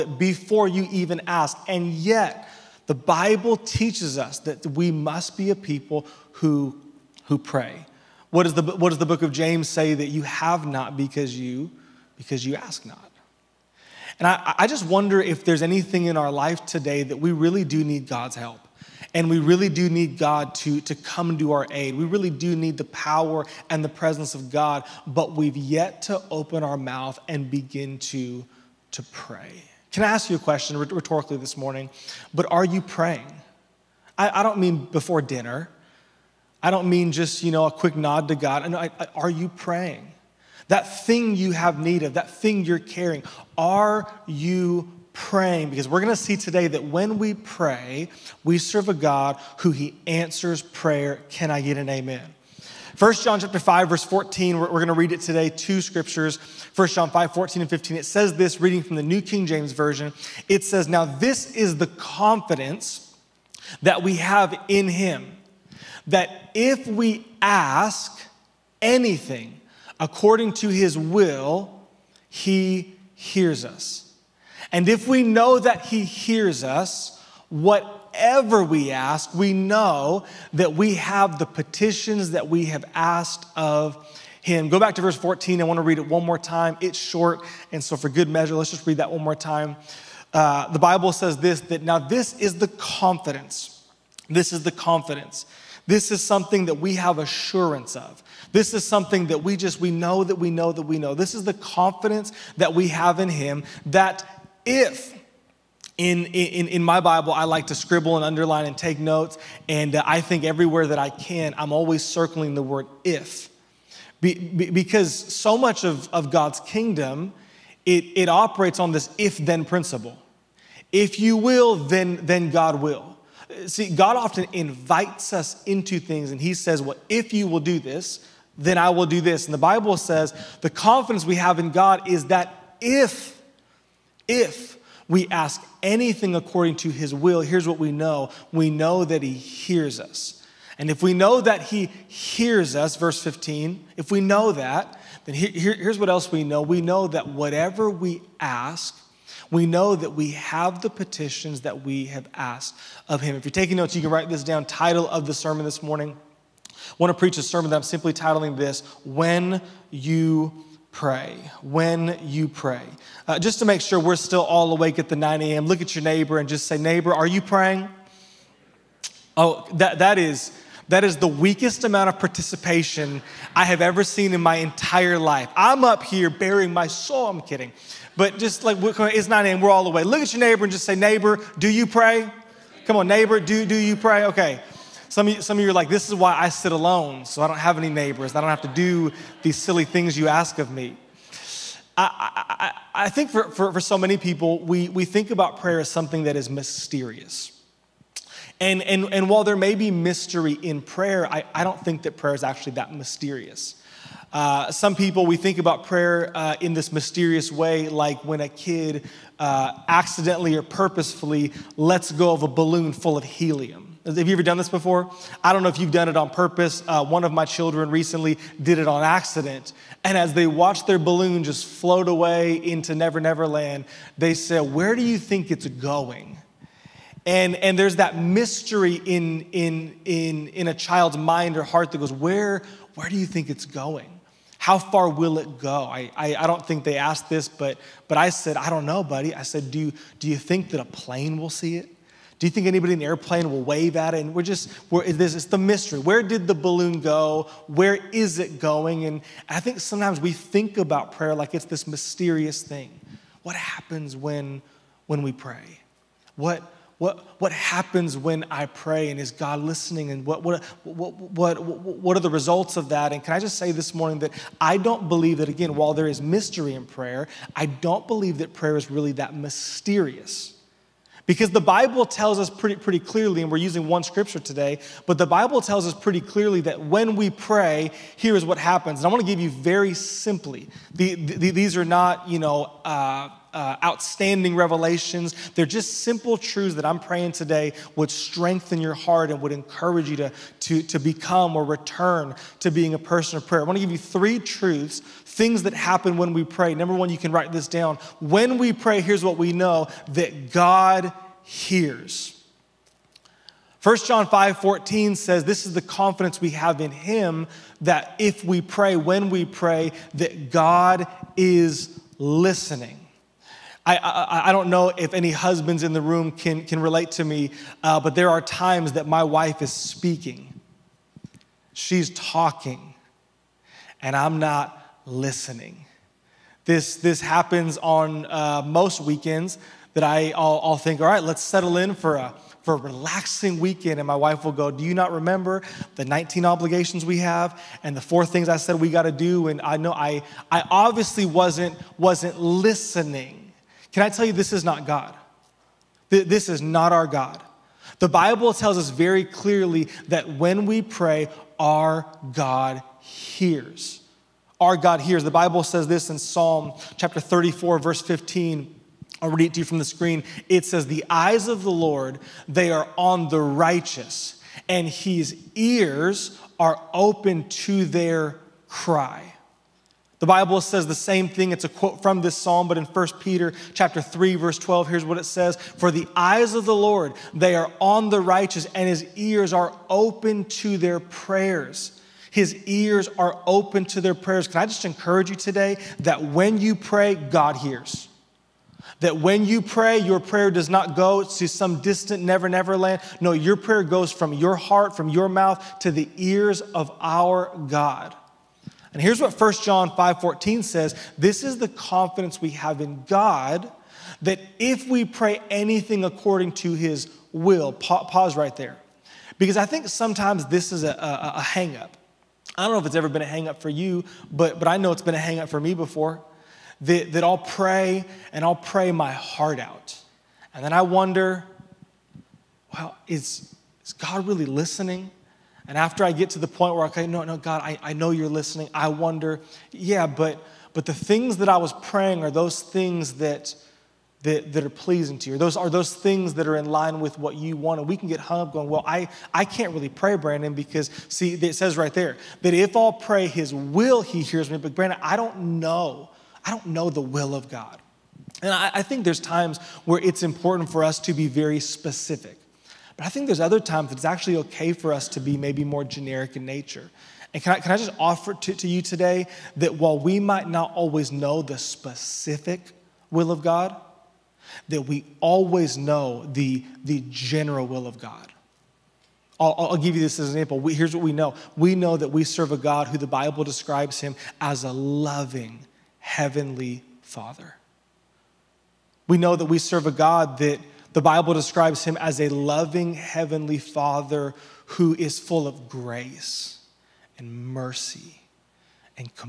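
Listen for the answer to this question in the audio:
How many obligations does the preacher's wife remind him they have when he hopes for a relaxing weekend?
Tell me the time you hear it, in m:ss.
5:36.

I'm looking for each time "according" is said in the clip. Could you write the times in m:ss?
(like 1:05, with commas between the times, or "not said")
1:09, 2:16, 6:46.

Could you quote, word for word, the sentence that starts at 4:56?
Number one, you can write this down.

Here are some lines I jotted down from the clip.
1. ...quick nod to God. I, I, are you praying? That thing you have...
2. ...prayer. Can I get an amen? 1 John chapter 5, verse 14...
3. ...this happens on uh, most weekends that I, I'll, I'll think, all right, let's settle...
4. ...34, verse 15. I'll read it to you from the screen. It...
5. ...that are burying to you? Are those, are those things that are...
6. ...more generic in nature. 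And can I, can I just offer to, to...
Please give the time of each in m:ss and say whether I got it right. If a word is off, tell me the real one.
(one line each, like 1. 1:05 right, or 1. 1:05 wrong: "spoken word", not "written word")
1. 0:37 right
2. 0:50 right
3. 5:26 right
4. 5:57 right
5. 7:14 wrong: "pleasing", not "burying"
6. 7:35 right.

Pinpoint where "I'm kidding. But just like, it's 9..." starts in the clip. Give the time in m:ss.
2:57.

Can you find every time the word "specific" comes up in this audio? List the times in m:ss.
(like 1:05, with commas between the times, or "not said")
7:31, 7:41.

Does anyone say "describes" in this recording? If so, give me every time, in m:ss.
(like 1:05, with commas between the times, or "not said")
7:53, 8:01.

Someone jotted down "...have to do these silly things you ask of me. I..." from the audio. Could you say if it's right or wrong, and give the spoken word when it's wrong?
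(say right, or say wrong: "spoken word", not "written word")
right.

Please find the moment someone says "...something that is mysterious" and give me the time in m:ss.
3:15.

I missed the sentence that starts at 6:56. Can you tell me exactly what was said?
That, that I'll pray and I'll pray my heart out.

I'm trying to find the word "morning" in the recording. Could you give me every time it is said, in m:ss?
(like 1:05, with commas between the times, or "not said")
0:31, 2:35, 4:23.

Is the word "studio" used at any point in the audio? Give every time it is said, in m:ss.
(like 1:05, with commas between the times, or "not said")
not said.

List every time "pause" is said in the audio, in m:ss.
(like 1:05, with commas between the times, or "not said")
6:48.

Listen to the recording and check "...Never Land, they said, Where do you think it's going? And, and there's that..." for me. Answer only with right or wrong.
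right.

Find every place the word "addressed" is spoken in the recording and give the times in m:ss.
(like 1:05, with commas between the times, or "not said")
not said.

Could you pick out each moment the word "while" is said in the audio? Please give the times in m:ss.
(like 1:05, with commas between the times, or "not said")
3:19, 4:25, 7:39.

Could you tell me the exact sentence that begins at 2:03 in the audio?
See, God often invites us into things and He says, Well, if you will do this, then I will do this.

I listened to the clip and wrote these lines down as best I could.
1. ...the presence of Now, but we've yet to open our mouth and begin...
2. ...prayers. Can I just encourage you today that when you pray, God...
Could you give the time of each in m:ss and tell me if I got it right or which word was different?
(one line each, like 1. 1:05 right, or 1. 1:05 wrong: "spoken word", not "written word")
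1. 0:23 wrong: "God", not "Now"
2. 6:24 right.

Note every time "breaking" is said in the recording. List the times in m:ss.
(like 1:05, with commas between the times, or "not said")
not said.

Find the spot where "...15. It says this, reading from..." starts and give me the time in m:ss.
0:57.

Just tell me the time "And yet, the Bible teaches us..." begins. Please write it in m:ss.
0:01.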